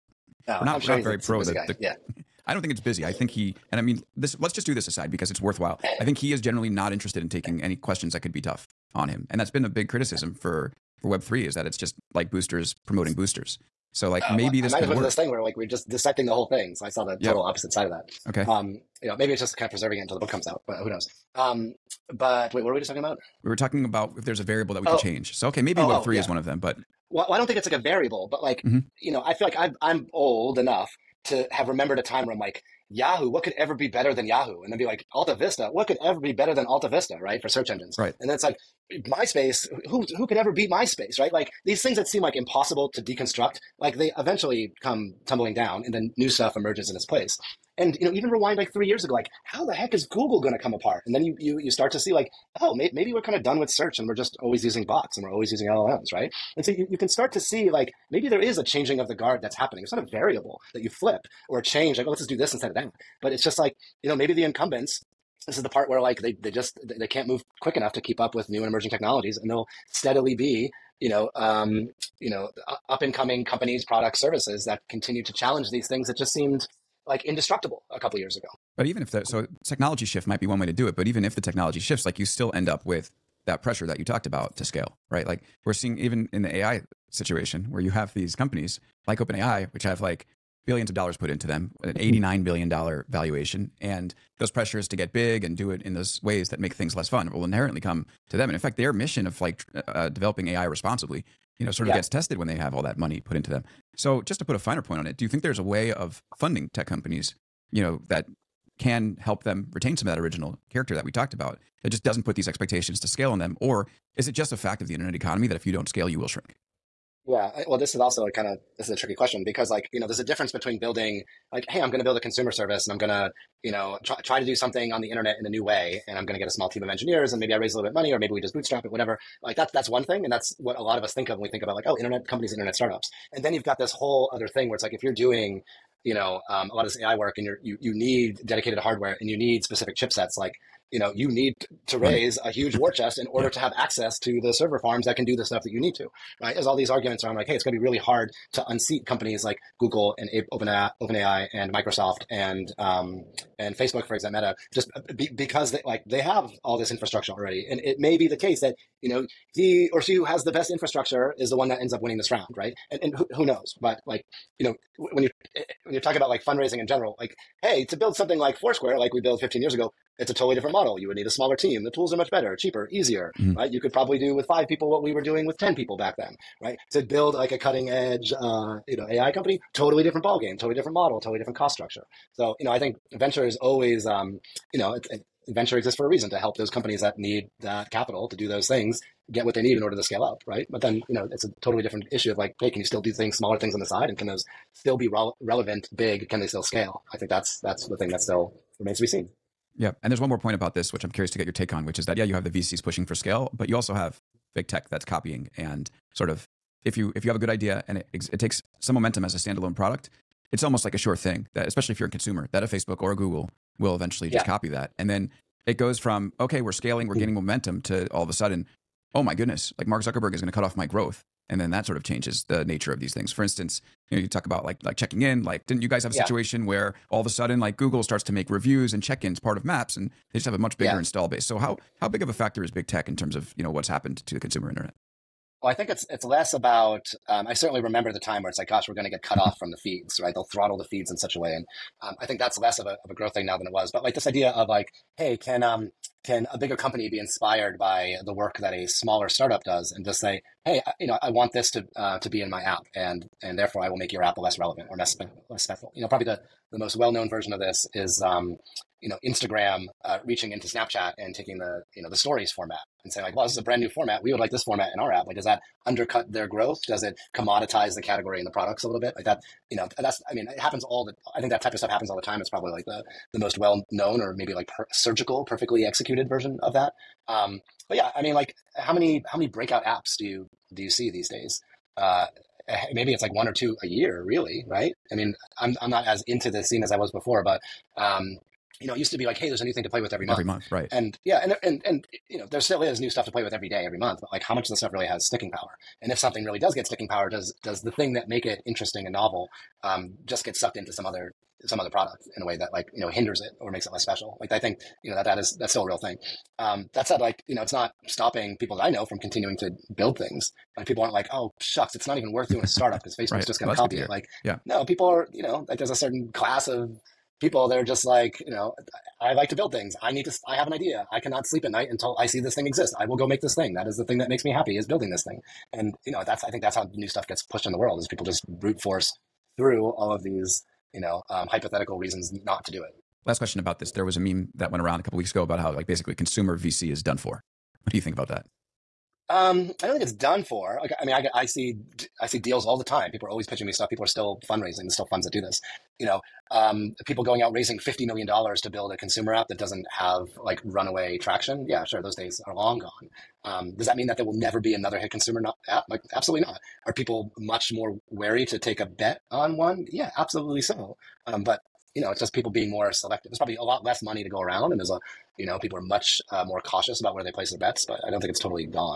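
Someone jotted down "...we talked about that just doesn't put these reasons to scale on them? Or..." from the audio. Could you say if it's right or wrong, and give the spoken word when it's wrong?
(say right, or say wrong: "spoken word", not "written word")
wrong: "expectations", not "reasons".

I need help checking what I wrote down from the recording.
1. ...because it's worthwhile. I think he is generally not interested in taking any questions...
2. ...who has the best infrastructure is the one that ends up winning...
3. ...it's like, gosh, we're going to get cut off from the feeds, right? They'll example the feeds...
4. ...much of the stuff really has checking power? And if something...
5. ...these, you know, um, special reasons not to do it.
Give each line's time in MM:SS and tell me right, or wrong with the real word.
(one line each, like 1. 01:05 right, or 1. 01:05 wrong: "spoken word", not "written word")
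1. 00:05 right
2. 02:40 right
3. 03:58 wrong: "throttle", not "example"
4. 04:54 wrong: "sticking", not "checking"
5. 05:30 wrong: "hypothetical", not "special".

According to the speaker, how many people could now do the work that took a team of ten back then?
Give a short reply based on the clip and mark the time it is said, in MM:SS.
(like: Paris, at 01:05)
5, at 02:54.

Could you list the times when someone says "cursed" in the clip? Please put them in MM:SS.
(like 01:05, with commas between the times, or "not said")
not said.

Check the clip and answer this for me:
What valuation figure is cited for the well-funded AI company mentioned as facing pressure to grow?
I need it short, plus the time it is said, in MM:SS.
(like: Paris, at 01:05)
$89 billion, at 01:32.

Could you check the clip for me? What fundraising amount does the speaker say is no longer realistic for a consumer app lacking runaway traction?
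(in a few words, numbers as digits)
$50 million.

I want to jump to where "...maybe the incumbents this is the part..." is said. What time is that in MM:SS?
01:04.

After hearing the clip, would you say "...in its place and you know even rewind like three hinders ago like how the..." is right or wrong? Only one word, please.
wrong.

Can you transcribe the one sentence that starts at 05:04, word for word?
Like I think you know that that is that's still a real thing.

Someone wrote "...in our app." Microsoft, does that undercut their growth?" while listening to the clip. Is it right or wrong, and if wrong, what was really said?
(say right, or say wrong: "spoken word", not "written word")
wrong: "Like", not "Microsoft".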